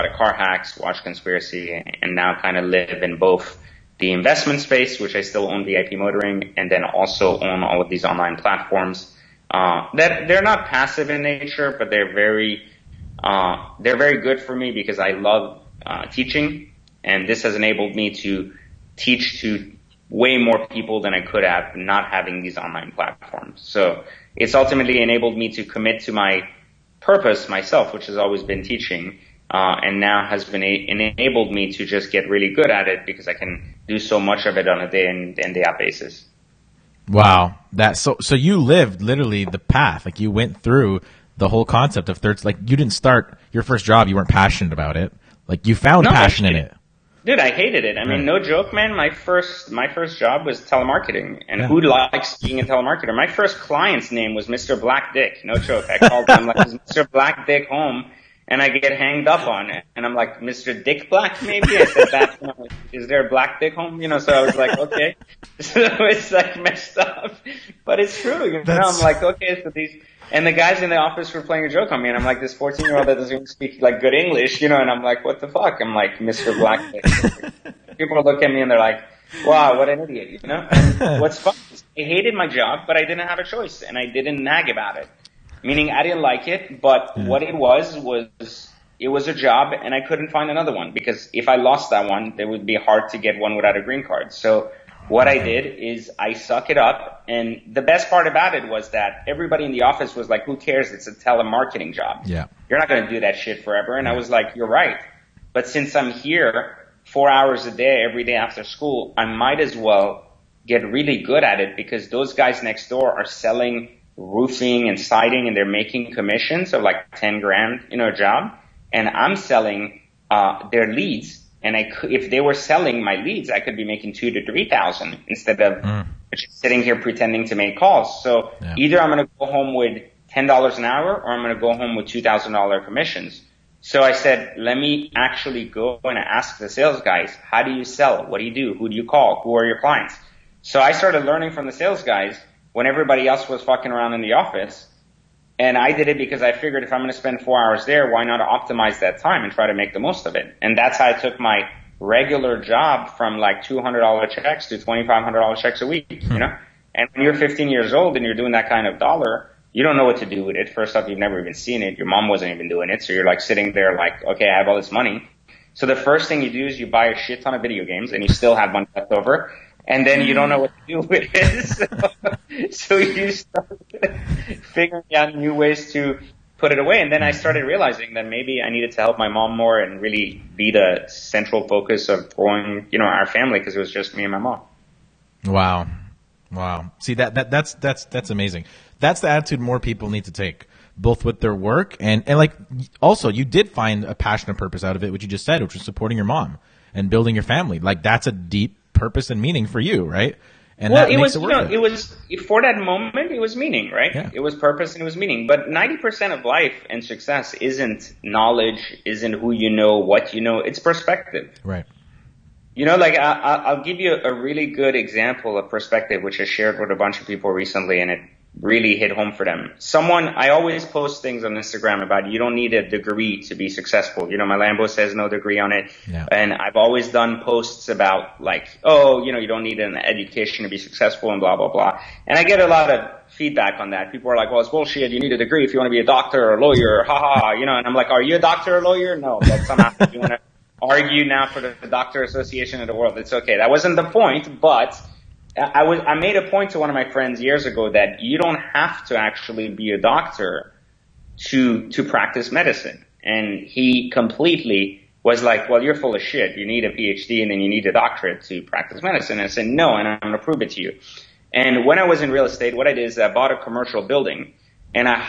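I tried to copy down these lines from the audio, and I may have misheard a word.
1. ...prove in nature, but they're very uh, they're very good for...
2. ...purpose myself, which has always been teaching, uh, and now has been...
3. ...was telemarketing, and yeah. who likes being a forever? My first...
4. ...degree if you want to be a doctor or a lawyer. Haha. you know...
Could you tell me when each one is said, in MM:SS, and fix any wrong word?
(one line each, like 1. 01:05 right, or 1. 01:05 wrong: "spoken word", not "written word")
1. 00:10 wrong: "passive", not "prove"
2. 00:26 right
3. 00:50 wrong: "telemarketer", not "forever"
4. 03:55 right.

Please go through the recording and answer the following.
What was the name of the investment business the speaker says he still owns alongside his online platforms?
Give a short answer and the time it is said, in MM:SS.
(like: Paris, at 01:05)
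VIP Motoring, at 00:05.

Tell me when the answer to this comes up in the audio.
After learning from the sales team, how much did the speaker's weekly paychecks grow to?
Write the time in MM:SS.
02:34.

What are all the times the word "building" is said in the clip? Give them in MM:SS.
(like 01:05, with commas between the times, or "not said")
03:17, 04:24.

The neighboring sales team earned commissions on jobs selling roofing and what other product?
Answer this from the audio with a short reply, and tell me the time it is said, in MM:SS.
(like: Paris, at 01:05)
Siding, at 01:54.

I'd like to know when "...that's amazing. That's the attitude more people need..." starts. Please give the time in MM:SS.
03:08.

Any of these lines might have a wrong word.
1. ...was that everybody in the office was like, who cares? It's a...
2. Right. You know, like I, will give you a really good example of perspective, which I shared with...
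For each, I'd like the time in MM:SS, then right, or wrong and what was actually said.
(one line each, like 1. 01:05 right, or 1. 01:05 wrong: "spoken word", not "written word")
1. 01:38 right
2. 03:31 right.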